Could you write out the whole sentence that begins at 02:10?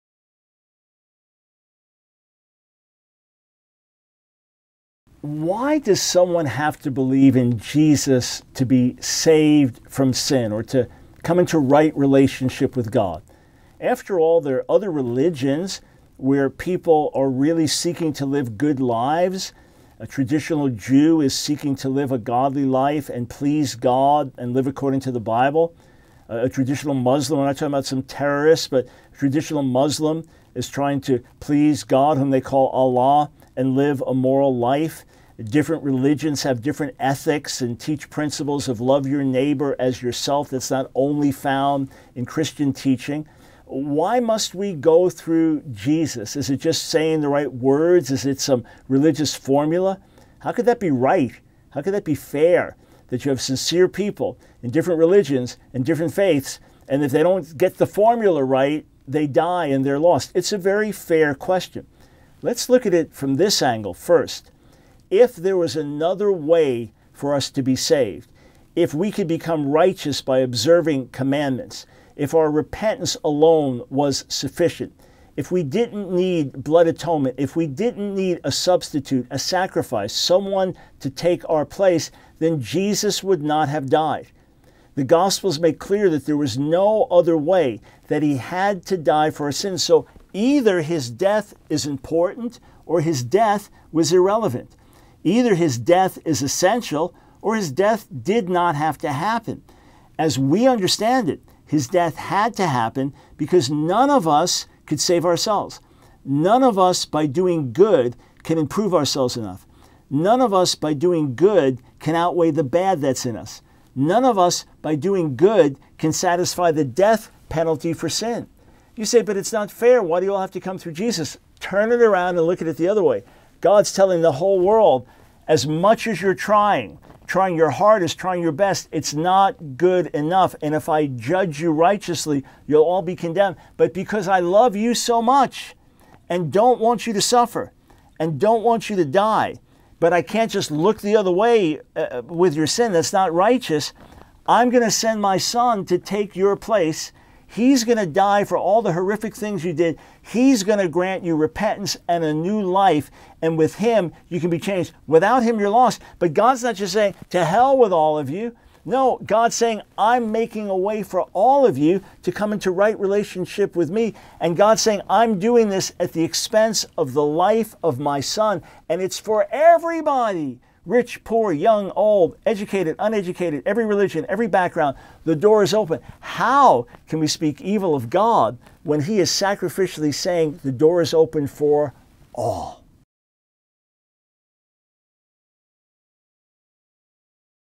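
And if I judge you righteously, you'll all be condemned.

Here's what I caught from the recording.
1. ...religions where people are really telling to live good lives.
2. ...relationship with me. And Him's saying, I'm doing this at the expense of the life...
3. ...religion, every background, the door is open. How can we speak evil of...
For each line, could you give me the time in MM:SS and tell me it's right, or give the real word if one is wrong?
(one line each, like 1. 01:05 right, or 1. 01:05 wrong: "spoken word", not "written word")
1. 00:14 wrong: "seeking", not "telling"
2. 02:42 wrong: "God", not "Him"
3. 02:53 right.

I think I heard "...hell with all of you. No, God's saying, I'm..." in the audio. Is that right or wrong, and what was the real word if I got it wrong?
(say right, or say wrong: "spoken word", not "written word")
right.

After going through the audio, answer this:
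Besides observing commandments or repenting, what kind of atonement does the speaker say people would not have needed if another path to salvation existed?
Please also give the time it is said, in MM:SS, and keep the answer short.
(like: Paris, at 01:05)
blood atonement, at 01:16.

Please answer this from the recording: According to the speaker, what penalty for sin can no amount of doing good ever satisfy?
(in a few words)
death penalty.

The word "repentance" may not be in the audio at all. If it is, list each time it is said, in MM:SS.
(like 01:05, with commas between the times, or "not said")
01:12, 02:31.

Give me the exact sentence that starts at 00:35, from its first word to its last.
Different religions have different ethics and teach principles of love your neighbor as yourself that's not only found in Christian teaching.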